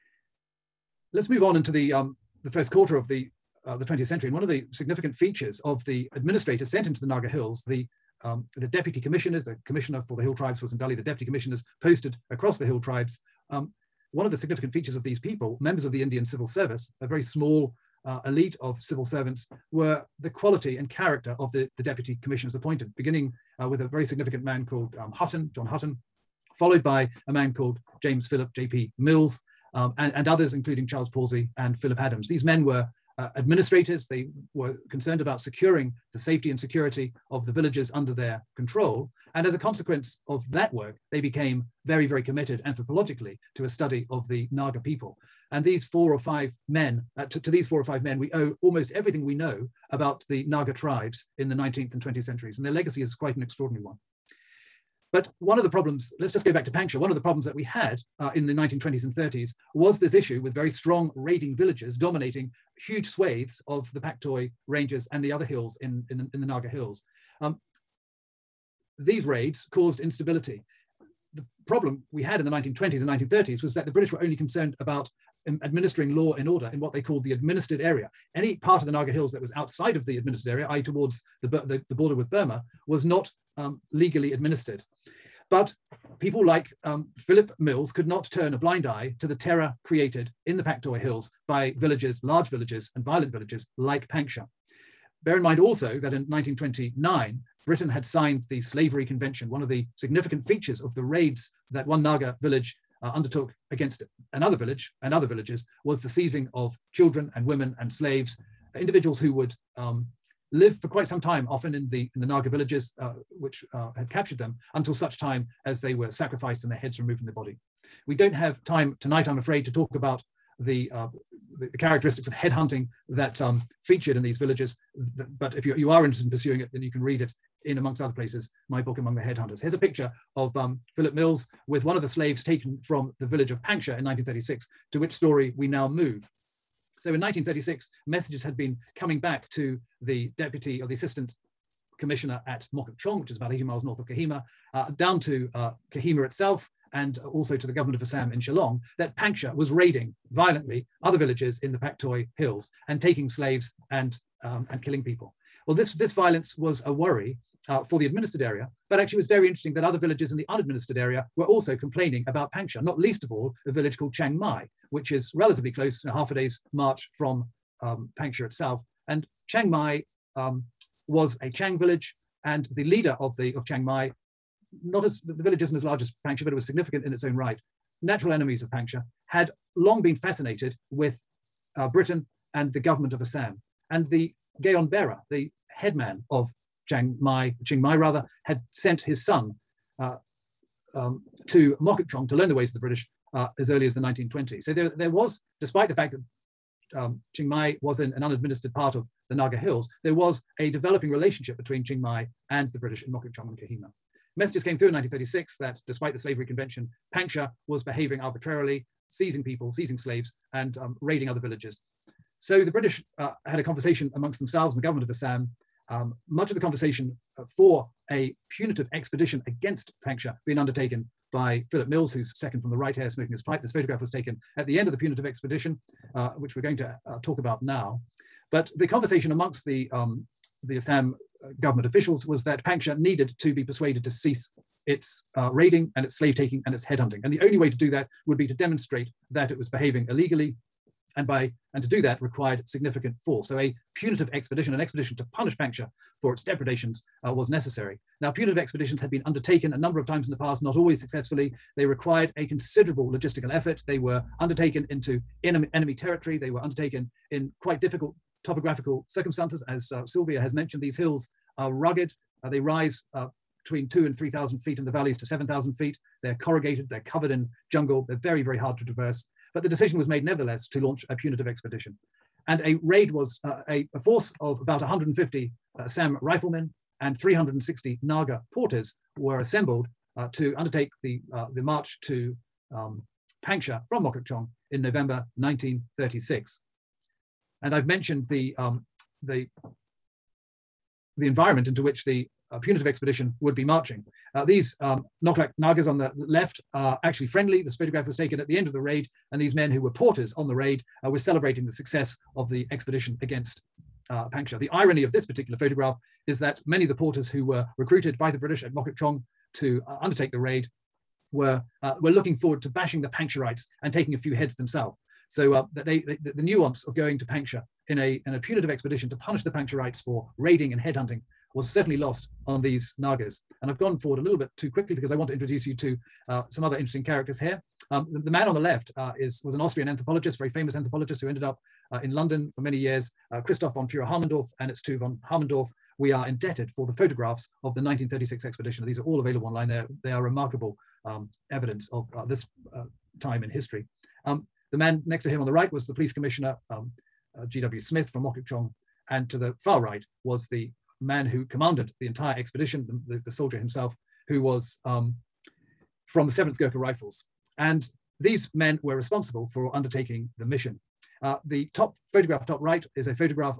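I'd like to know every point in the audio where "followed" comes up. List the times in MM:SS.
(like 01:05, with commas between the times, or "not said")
00:26.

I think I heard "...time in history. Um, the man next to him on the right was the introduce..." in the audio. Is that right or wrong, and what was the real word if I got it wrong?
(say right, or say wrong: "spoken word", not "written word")
wrong: "police", not "introduce".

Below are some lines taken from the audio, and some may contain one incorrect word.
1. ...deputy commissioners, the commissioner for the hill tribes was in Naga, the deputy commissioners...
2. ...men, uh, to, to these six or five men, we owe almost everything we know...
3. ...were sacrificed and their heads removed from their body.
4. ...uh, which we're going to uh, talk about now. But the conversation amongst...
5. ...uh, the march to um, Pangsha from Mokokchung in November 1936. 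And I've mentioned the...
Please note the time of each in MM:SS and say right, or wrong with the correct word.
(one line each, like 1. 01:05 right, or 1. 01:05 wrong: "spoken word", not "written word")
1. 00:08 wrong: "Dali", not "Naga"
2. 00:46 wrong: "four", not "six"
3. 01:55 right
4. 03:46 right
5. 04:41 right.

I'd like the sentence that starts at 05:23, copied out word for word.
And I've gone forward a little bit too quickly because I want to introduce you to uh, some other interesting characters here.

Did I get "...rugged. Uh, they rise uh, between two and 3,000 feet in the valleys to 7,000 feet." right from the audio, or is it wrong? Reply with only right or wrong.
right.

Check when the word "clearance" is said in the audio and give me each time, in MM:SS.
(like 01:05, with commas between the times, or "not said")
not said.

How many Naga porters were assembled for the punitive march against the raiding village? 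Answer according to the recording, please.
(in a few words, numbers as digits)
360.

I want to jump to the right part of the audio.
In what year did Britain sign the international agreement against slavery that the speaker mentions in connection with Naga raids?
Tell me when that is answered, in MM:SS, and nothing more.
01:36.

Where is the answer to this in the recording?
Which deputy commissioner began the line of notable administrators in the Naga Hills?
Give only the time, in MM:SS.
00:25.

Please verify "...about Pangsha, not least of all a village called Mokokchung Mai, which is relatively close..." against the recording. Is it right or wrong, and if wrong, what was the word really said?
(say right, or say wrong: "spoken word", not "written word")
wrong: "Chiang", not "Mokokchung".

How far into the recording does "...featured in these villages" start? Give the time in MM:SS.
02:03.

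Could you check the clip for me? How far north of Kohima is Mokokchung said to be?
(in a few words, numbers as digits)
80 miles.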